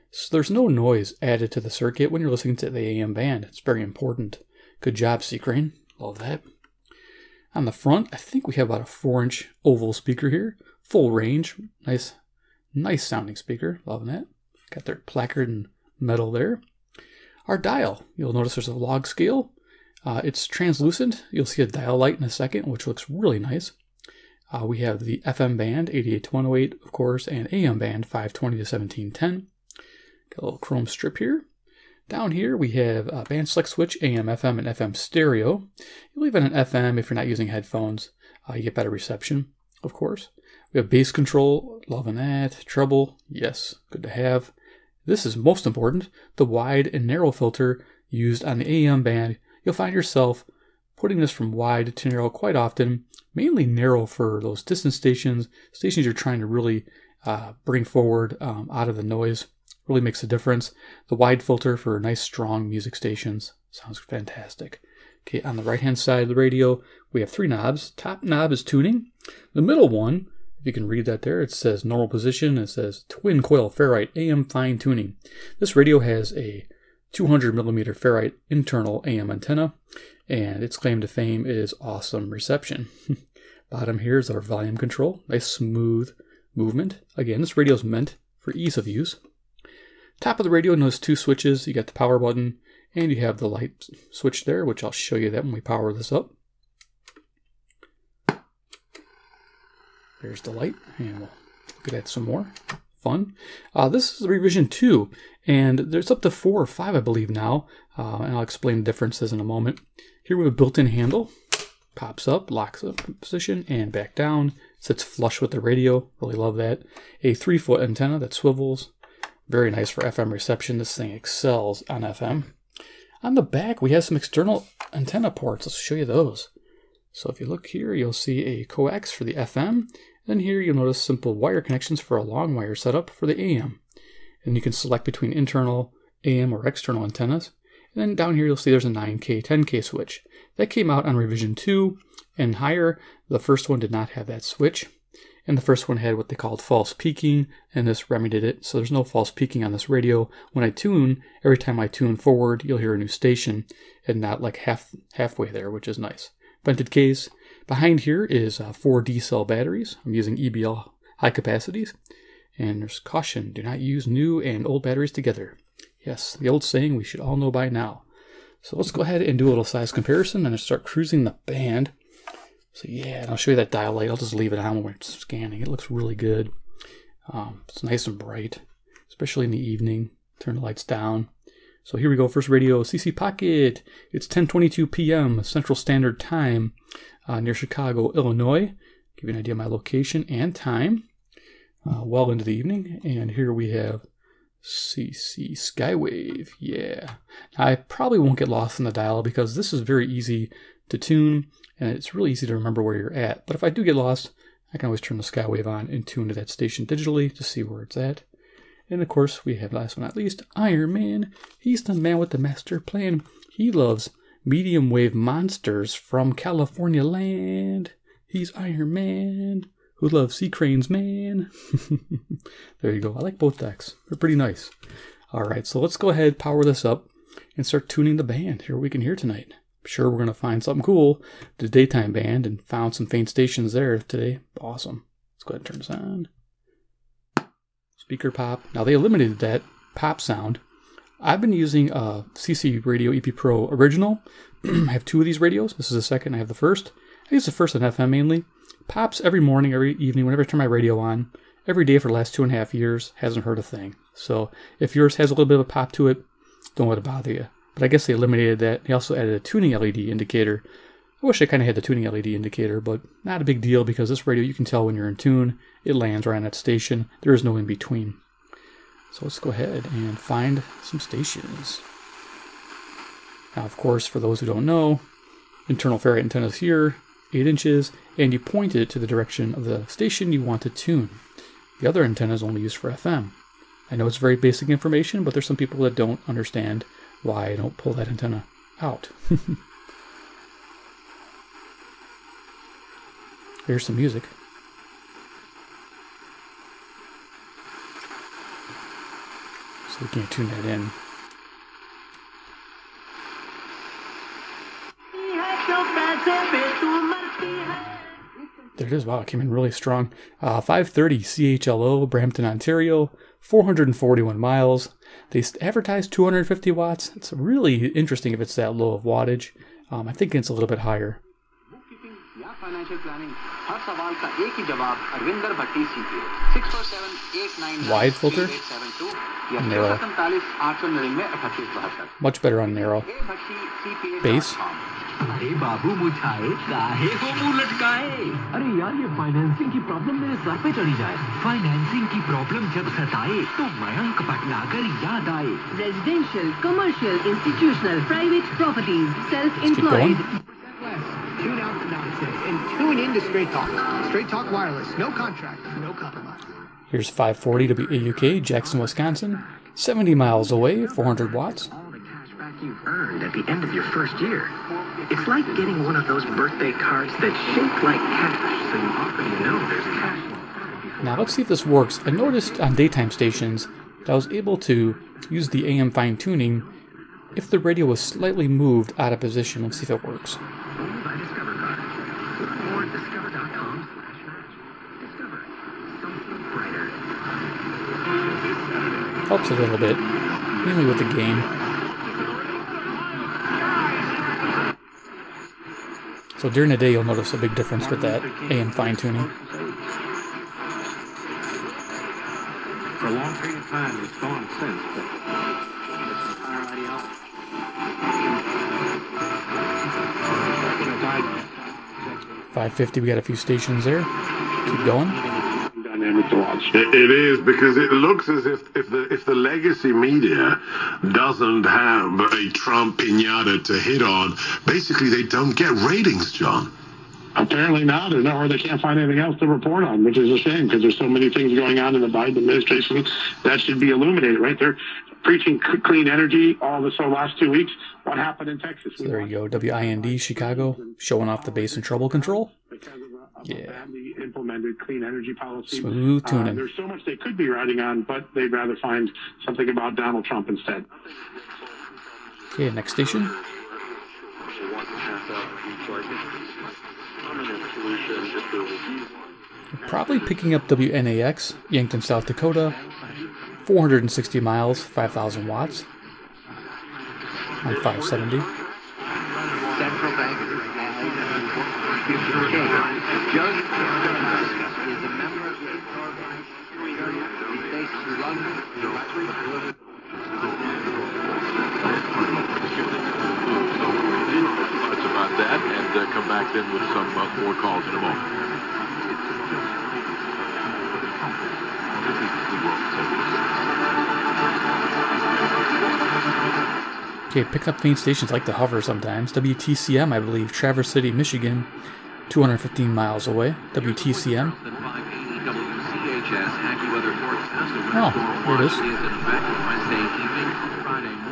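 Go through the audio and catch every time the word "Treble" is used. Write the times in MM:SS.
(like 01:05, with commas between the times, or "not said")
00:42.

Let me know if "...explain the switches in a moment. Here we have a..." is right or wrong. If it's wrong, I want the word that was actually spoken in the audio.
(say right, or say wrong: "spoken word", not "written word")
wrong: "differences", not "switches".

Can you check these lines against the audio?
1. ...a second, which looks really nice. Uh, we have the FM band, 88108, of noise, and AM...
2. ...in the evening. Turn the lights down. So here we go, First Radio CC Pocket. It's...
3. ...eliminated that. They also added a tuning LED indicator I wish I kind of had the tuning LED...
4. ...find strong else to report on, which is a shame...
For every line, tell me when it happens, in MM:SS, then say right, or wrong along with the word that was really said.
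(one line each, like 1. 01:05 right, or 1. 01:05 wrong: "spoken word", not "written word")
1. 00:22 wrong: "course", not "noise"
2. 02:59 right
3. 04:18 right
4. 07:08 wrong: "anything", not "strong".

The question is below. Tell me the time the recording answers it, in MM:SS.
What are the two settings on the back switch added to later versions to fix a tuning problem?
02:18.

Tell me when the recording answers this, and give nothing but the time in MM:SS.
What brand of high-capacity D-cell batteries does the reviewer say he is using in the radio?
02:40.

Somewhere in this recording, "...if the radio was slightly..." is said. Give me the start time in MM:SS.
06:17.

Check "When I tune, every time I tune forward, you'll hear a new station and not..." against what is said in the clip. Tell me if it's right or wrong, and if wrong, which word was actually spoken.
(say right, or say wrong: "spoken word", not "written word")
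right.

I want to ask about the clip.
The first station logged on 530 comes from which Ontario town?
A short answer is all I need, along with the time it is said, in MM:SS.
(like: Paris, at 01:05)
Brampton, at 05:12.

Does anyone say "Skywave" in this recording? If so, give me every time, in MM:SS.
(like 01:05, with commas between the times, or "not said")
03:15, 03:25.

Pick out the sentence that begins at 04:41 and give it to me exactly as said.
The other antenna is only used for FM.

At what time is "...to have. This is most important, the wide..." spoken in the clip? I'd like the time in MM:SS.
00:44.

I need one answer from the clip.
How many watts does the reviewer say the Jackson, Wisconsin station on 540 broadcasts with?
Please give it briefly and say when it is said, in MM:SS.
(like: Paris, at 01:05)
400 watts, at 06:00.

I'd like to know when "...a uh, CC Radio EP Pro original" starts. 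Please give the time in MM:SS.
04:01.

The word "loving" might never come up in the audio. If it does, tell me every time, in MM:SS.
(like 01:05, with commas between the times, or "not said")
00:13, 00:41.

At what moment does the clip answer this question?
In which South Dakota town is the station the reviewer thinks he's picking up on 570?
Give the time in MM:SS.
07:41.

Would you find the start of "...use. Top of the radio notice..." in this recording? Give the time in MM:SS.
01:28.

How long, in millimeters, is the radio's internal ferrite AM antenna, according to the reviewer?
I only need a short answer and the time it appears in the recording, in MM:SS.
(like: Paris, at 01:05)
200 millimeters, at 01:17.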